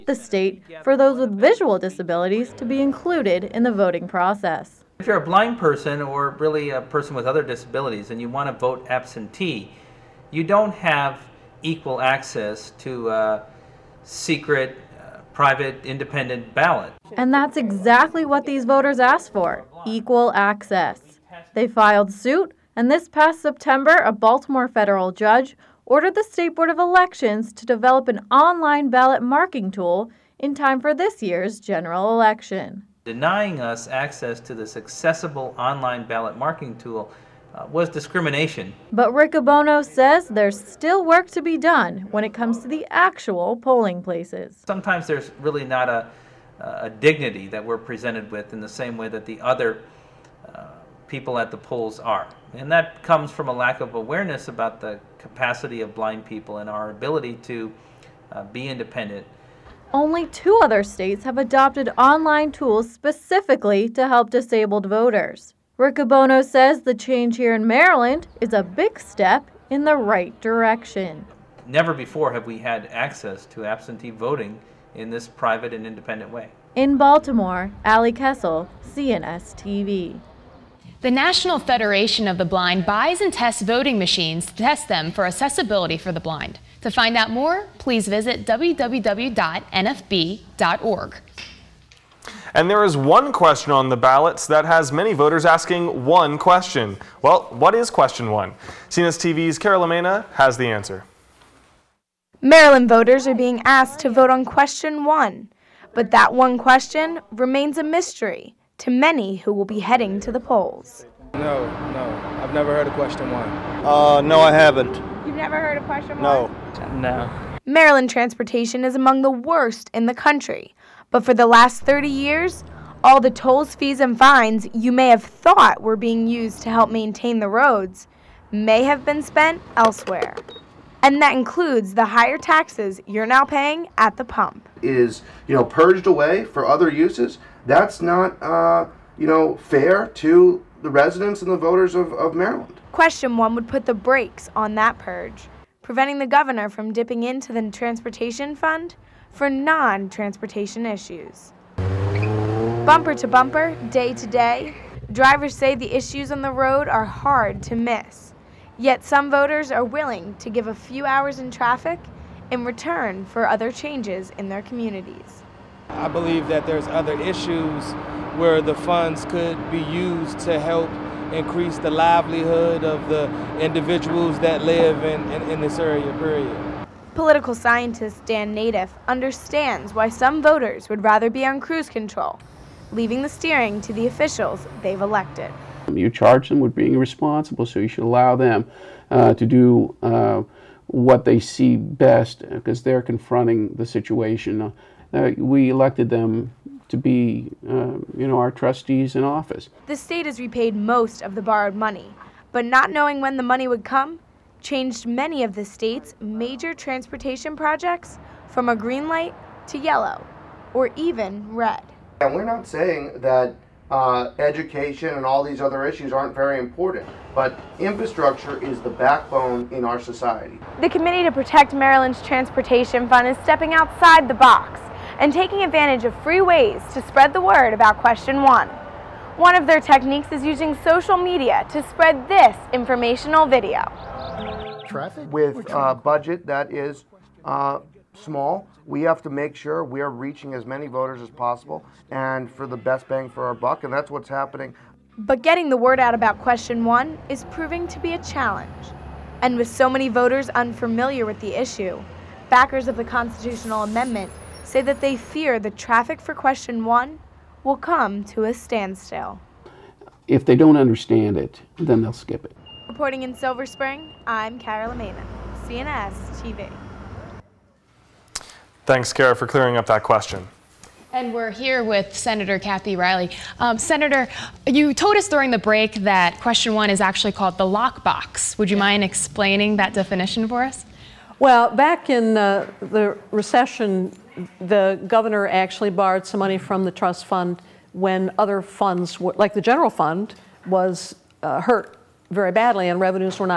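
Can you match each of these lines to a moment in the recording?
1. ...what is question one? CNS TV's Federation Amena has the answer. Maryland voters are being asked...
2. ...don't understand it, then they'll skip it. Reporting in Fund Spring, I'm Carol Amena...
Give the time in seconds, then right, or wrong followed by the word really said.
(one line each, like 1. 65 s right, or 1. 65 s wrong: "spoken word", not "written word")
1. 97 s wrong: "Carol", not "Federation"
2. 260 s wrong: "Silver", not "Fund".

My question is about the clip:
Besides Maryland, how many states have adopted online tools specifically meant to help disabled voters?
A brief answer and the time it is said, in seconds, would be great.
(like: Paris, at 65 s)
2, at 59 s.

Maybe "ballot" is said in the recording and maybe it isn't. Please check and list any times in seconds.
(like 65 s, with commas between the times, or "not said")
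16 s, 28 s, 36 s, 93 s.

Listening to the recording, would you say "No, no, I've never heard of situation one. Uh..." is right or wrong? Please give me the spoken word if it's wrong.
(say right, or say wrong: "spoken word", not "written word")
wrong: "question", not "situation".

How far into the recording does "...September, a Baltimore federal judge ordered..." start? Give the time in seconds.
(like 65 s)
23 s.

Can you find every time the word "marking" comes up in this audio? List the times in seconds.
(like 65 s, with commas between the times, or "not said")
29 s, 36 s.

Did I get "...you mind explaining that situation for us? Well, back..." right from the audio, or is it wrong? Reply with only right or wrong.
wrong.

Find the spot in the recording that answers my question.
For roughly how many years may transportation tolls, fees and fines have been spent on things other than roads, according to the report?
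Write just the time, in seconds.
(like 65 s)
121 s.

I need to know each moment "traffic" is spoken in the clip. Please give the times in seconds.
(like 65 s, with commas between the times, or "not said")
161 s, 234 s, 255 s.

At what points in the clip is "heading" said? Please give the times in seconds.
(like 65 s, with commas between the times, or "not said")
109 s.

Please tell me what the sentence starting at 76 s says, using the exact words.
In Baltimore, Ali Kessel, CNS TV.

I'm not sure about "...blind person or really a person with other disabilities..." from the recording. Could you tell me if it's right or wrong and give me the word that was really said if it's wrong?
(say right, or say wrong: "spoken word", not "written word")
right.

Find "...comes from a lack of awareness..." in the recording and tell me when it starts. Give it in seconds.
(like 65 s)
53 s.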